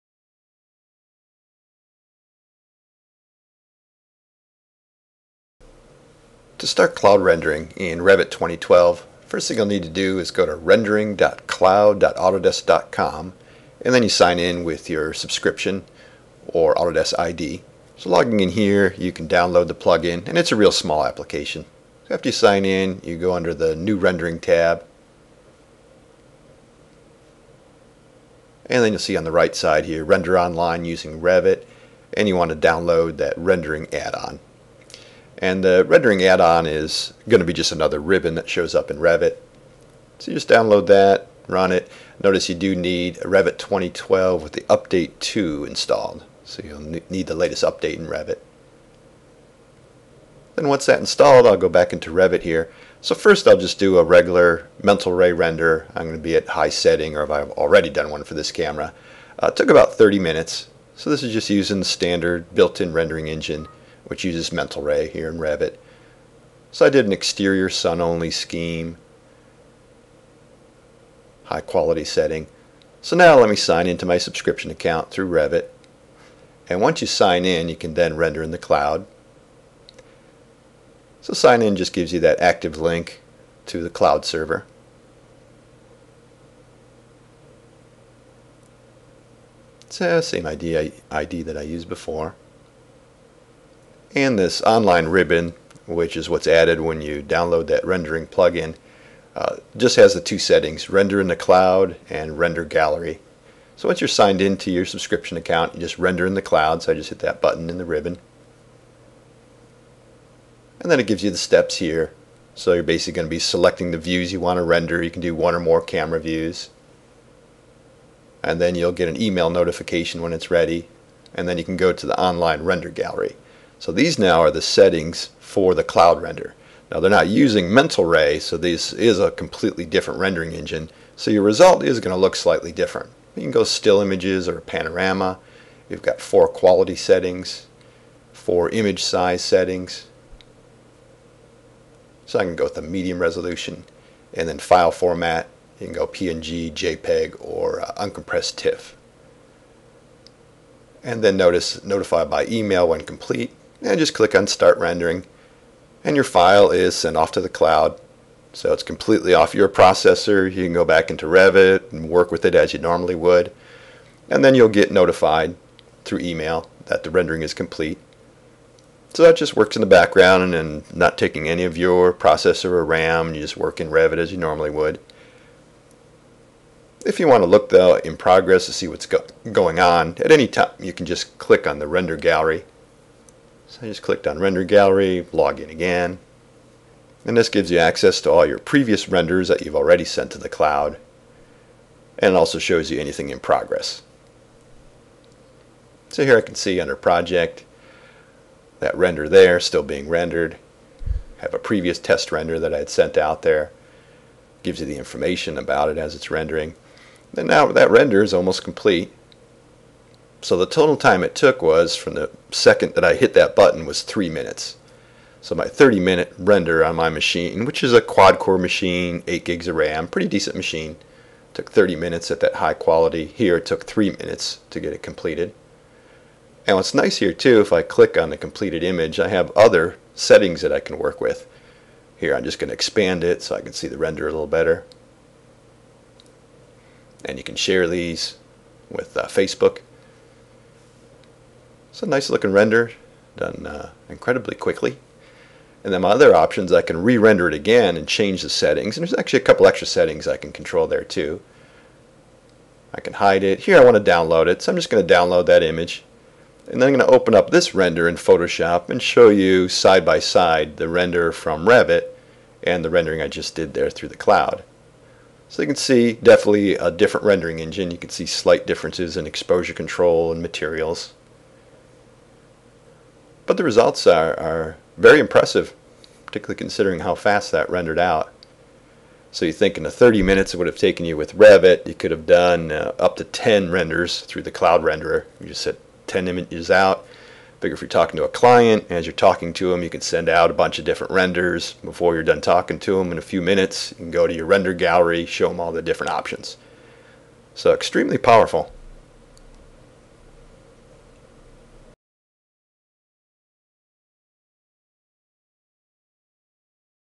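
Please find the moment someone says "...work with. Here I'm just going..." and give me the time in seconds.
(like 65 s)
230 s.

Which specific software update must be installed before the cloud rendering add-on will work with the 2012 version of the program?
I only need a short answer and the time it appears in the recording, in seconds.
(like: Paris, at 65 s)
update 2, at 44 s.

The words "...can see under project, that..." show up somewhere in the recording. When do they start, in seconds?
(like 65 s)
196 s.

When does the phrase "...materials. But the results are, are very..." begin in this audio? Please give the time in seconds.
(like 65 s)
270 s.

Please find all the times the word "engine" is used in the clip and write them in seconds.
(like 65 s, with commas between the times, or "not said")
63 s, 130 s, 267 s.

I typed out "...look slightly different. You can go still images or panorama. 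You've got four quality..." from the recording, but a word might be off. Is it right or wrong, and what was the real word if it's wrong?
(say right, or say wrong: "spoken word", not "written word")
right.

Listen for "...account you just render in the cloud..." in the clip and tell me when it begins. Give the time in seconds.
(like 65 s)
105 s.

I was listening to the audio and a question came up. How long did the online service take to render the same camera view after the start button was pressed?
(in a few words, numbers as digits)
3 minutes.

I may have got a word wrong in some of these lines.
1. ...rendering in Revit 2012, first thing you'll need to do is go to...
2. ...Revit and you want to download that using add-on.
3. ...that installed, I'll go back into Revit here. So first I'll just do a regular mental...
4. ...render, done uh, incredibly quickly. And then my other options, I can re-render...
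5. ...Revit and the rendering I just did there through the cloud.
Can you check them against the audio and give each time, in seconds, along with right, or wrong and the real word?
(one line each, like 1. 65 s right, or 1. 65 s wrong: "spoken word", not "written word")
1. 7 s right
2. 31 s wrong: "rendering", not "using"
3. 50 s right
4. 242 s right
5. 261 s right.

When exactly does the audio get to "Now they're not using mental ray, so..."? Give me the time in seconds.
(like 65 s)
126 s.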